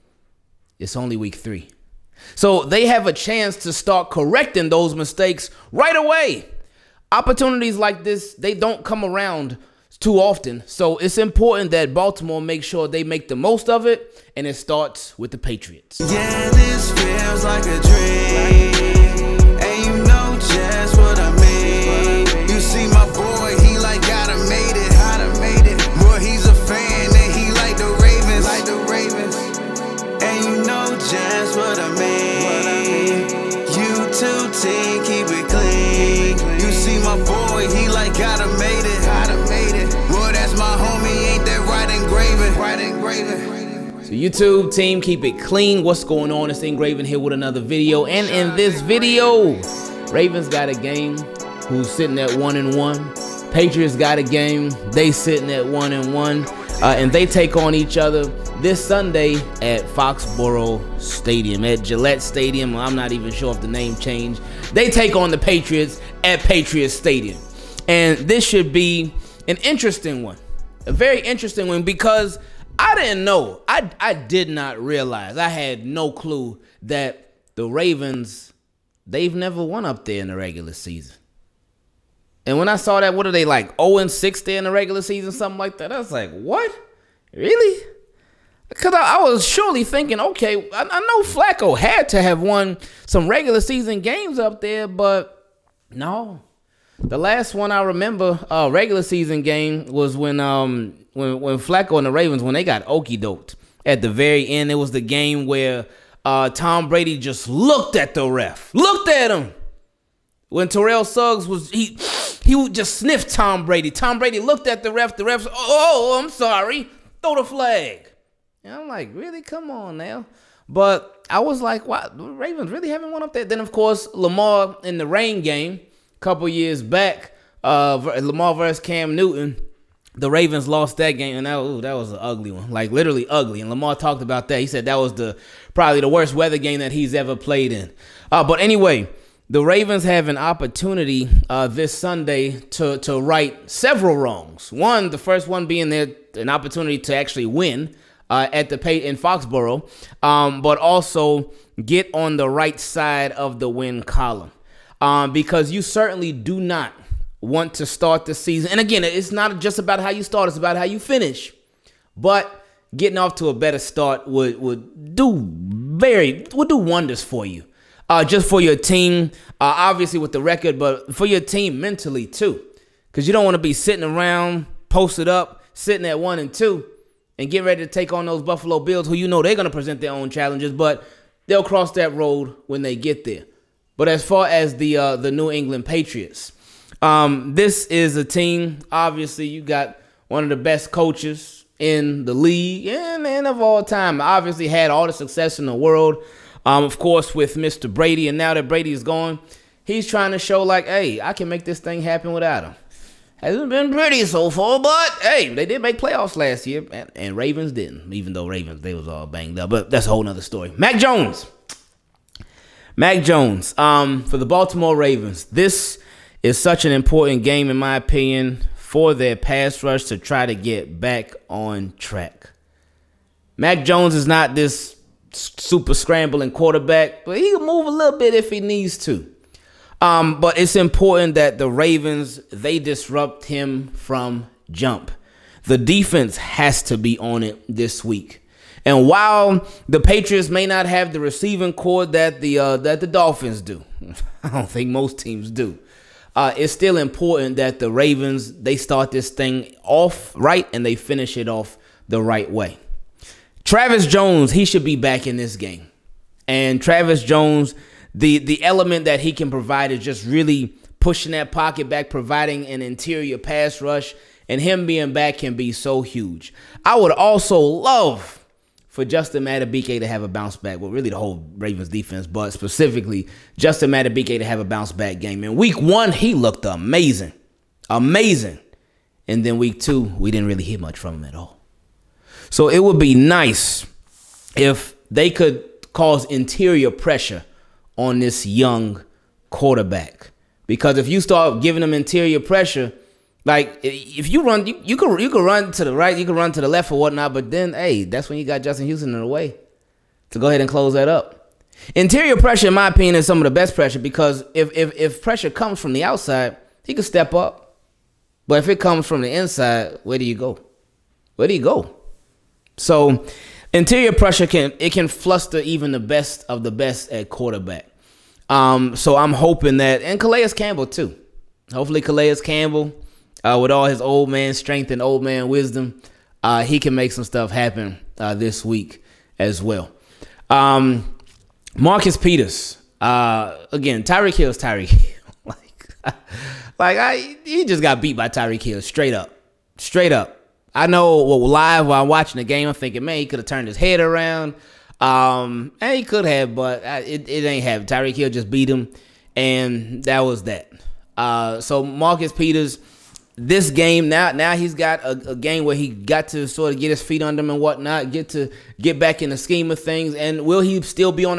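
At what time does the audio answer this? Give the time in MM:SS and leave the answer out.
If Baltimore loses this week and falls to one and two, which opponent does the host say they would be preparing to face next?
02:58.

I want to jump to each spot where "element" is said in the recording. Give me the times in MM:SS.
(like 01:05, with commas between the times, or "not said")
04:18.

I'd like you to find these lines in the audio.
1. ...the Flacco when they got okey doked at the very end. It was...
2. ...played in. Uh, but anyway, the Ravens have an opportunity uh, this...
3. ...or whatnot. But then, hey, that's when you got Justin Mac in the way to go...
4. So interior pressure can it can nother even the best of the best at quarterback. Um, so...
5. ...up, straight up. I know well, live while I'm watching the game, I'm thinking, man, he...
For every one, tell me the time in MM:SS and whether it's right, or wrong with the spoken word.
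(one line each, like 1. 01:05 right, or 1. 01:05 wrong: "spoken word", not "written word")
1. 01:42 wrong: "Ravens", not "Flacco"
2. 02:17 right
3. 04:56 wrong: "Houston", not "Mac"
4. 05:12 wrong: "fluster", not "nother"
5. 05:39 right.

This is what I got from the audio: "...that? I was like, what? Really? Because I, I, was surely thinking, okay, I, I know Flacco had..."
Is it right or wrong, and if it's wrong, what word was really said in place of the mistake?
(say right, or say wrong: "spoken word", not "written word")
right.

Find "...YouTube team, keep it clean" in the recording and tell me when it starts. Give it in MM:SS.
00:44.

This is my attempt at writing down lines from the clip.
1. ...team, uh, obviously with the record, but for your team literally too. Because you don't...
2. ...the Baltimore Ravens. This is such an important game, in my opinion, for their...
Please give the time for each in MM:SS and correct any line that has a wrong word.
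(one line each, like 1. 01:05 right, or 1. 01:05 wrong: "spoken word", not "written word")
1. 02:48 wrong: "mentally", not "literally"
2. 03:34 right.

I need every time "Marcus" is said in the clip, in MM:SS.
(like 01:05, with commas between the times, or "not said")
05:31, 05:51.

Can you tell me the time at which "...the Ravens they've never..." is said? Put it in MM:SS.
01:17.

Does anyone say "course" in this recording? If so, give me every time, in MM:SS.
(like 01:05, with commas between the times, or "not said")
02:03, 03:16.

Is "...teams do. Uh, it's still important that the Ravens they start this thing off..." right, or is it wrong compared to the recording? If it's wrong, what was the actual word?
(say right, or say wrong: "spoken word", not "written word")
right.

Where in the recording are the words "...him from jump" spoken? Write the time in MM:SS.
03:53.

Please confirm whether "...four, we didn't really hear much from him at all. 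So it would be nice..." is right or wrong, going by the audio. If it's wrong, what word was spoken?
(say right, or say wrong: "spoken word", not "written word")
wrong: "two", not "four".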